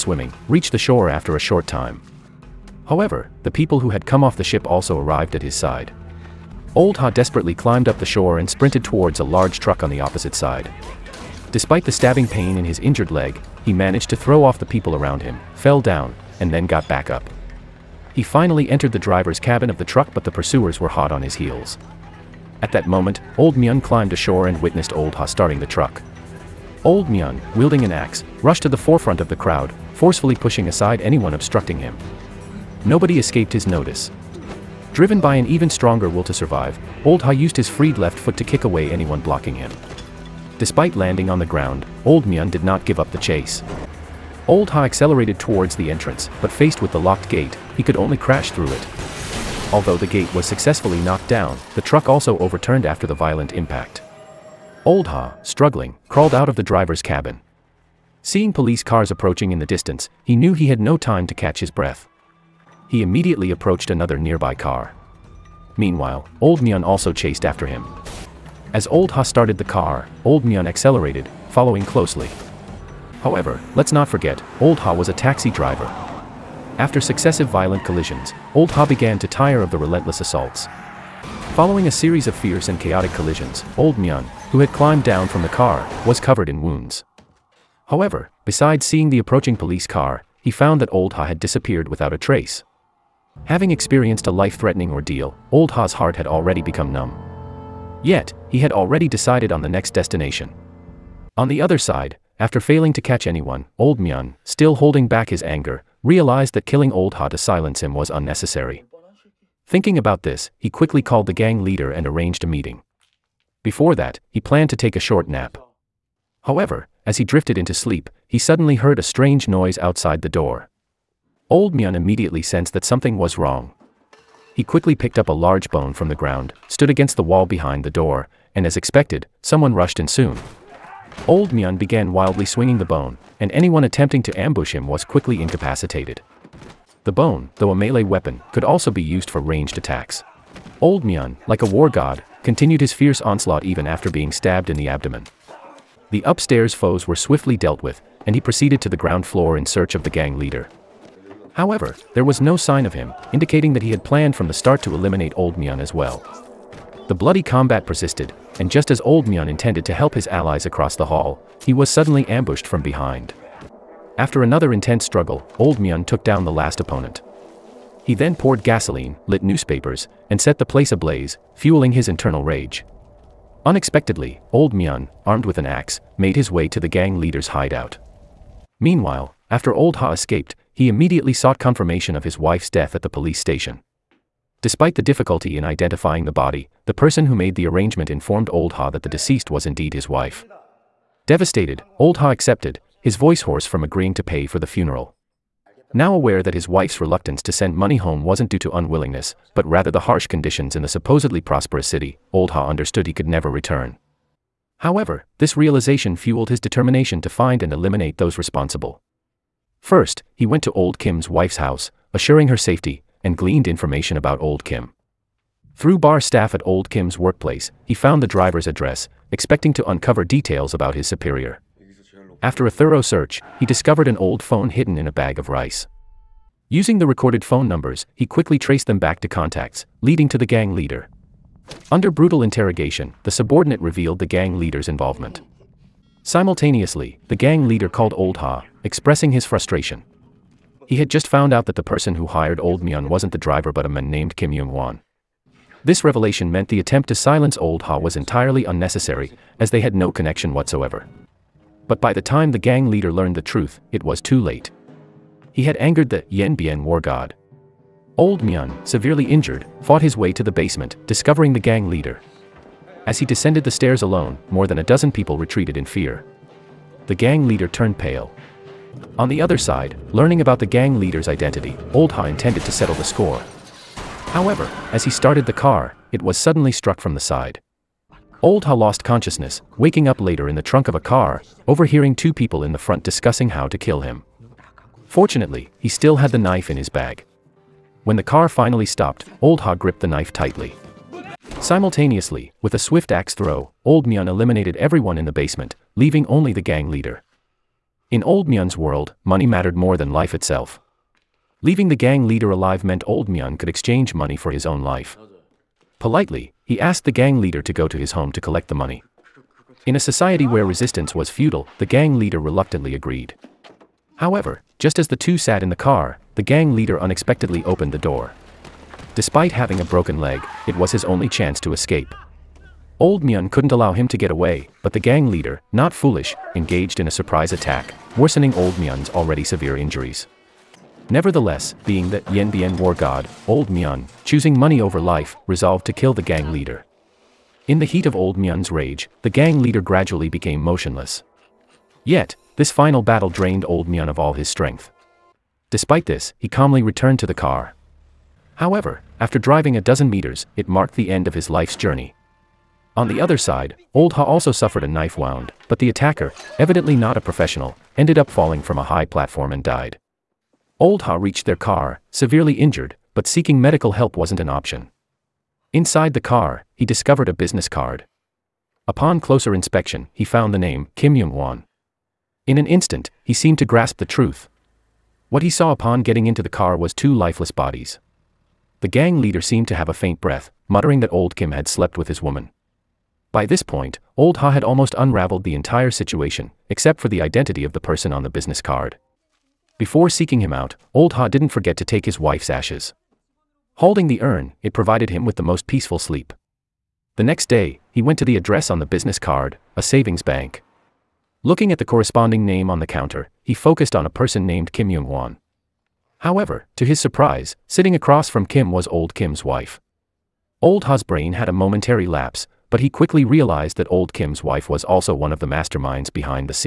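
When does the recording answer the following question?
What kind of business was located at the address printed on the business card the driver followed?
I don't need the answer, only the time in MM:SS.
06:39.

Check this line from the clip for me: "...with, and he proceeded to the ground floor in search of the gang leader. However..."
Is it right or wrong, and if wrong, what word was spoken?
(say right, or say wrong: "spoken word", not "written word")
right.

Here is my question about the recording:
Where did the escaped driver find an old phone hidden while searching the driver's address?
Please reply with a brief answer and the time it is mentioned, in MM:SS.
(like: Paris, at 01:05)
In a bag of rice, at 03:45.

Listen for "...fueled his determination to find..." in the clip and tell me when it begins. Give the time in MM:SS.
03:26.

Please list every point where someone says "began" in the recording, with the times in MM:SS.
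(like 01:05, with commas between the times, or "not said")
01:18, 02:11.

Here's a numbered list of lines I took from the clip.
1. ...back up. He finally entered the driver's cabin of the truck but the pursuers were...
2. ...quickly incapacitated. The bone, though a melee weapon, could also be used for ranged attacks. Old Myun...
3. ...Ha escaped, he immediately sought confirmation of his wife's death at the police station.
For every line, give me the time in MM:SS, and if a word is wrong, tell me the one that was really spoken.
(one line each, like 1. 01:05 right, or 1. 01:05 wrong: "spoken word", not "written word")
1. 00:16 right
2. 02:15 right
3. 02:59 right.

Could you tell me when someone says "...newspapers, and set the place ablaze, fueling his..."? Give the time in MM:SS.
02:49.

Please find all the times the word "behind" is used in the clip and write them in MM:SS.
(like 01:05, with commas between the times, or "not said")
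02:07, 02:42, 06:56.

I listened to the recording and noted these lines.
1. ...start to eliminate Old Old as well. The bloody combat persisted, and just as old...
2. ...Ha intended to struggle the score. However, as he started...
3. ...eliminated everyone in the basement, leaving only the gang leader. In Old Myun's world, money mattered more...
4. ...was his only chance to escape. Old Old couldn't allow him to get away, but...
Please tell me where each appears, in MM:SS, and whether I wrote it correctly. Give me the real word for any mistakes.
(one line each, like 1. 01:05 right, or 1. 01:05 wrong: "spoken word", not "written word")
1. 02:34 wrong: "Myun", not "Old"
2. 04:32 wrong: "settle", not "struggle"
3. 04:54 right
4. 05:20 wrong: "Myun", not "Old".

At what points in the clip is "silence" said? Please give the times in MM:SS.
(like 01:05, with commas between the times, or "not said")
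01:47, 04:07.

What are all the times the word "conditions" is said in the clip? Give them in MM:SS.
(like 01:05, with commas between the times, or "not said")
03:20.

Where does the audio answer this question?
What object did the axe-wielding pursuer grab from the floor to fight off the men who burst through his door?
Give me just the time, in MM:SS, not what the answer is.
02:05.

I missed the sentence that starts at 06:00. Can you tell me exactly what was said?
Old Ha reached their car, severely injured, but seeking medical help wasn't an option.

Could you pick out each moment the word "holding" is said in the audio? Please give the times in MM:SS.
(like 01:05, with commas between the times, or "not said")
01:44, 06:33.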